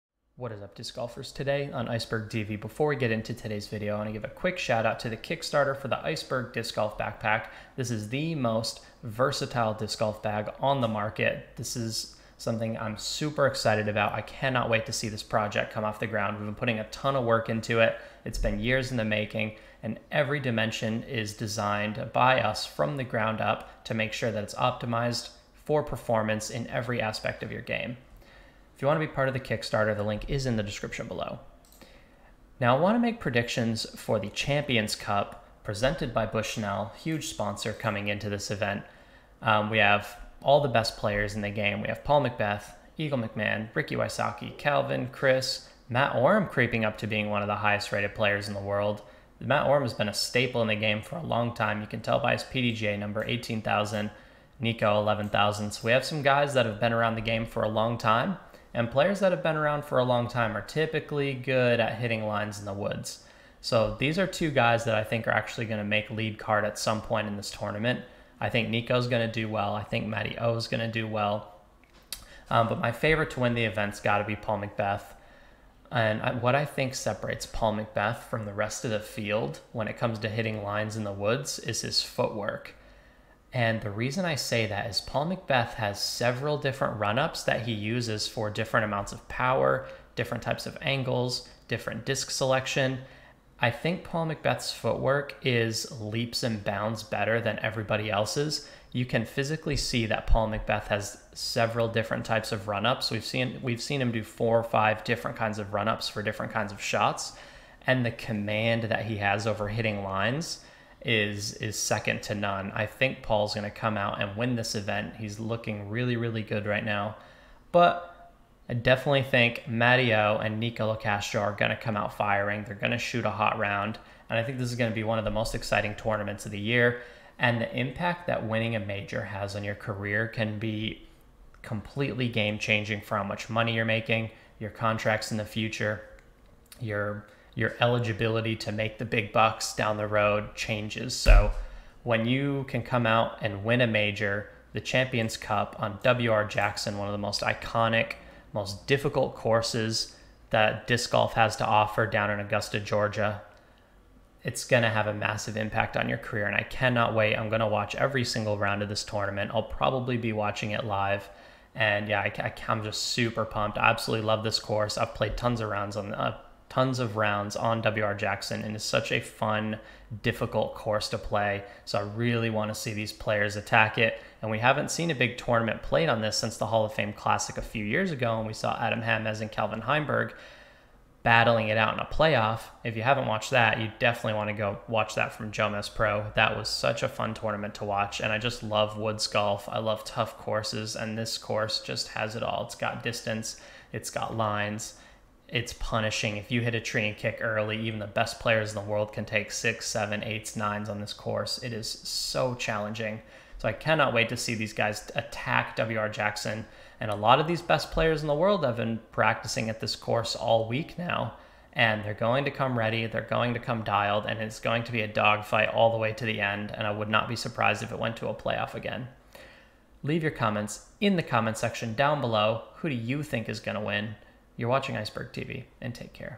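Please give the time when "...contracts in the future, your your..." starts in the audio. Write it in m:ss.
2:14.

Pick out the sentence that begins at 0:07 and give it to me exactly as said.
This is the most versatile disc golf bag on the market.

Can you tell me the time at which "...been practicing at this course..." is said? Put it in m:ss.
3:28.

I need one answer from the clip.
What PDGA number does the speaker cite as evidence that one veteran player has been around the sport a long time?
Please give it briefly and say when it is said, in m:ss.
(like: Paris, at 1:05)
18,000, at 0:53.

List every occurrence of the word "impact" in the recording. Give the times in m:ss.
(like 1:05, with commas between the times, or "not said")
2:07, 2:35.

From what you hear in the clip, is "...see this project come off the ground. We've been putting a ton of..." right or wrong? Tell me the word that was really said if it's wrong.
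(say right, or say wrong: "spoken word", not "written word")
right.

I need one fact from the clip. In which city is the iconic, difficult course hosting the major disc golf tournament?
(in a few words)
Augusta, Georgia.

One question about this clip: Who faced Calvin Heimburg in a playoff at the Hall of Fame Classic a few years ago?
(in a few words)
Adam Hammes.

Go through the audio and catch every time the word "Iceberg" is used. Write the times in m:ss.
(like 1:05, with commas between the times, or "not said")
0:01, 0:06, 3:44.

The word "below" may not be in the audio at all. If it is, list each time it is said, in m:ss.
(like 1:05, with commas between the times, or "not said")
0:31, 3:42.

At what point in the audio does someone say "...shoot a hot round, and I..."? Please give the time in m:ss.
2:02.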